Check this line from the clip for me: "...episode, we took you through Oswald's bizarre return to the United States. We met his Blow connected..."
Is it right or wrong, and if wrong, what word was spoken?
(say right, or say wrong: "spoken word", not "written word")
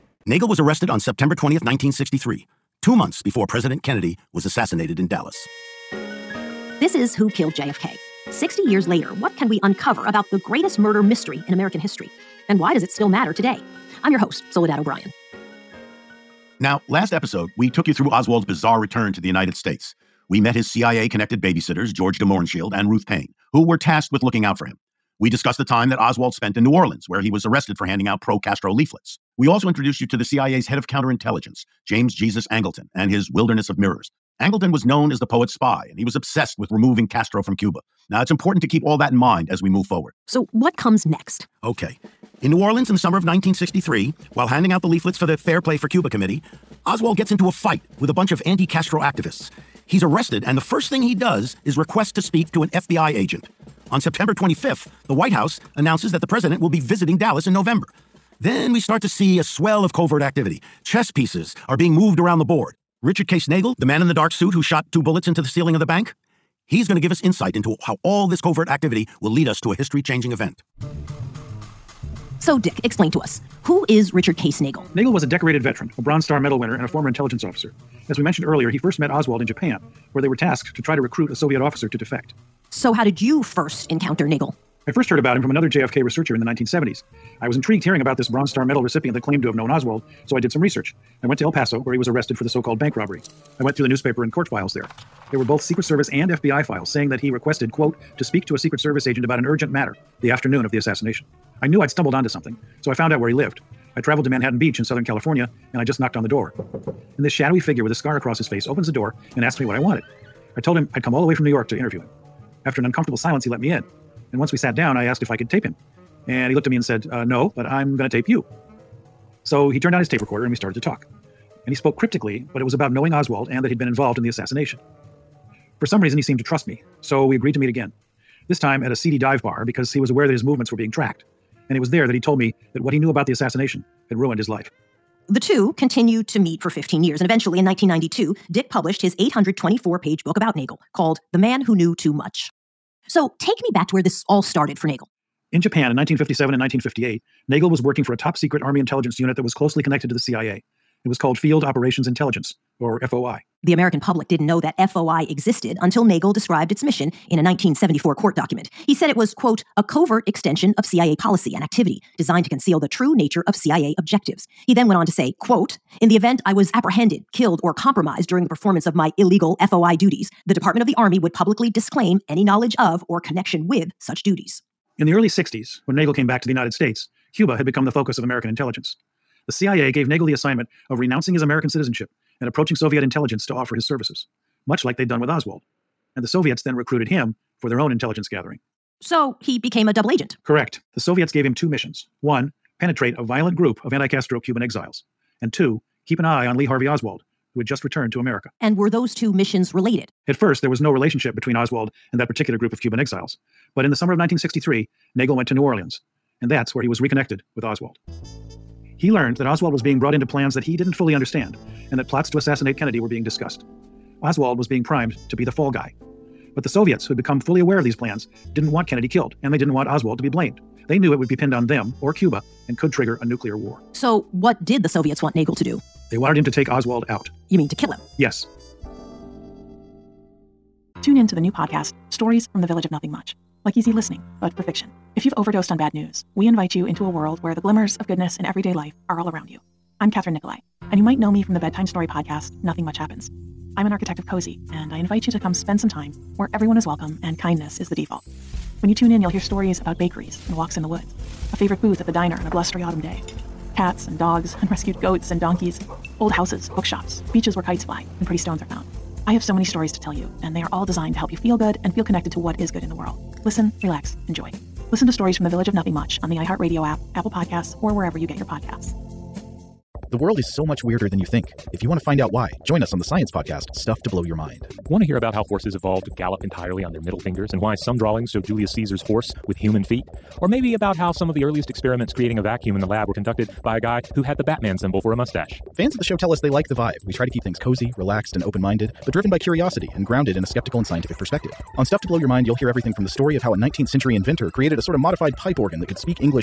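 wrong: "CIA", not "Blow".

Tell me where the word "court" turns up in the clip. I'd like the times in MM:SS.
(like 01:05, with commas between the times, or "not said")
01:34, 02:38.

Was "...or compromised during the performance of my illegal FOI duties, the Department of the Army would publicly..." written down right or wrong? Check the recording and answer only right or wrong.
right.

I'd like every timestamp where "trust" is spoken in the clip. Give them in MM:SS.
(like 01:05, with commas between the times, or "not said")
02:06.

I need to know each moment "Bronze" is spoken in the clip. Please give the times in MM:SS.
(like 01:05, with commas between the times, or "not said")
01:16, 01:28.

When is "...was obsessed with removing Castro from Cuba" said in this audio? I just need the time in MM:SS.
00:36.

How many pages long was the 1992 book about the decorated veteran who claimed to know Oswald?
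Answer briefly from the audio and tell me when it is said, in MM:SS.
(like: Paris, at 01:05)
824, at 02:19.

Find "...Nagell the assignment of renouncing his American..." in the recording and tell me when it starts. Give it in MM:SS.
03:00.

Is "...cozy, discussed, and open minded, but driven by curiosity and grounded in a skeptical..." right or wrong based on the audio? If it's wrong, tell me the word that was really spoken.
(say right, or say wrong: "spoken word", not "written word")
wrong: "relaxed", not "discussed".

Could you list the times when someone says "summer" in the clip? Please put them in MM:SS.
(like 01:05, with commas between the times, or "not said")
00:42, 03:23.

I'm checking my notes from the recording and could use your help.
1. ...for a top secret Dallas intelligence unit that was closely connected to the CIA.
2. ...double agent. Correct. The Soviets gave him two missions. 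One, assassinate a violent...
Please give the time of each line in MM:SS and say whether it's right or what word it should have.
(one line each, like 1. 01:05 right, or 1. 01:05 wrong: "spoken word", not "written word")
1. 02:28 wrong: "Army", not "Dallas"
2. 03:09 wrong: "penetrate", not "assassinate".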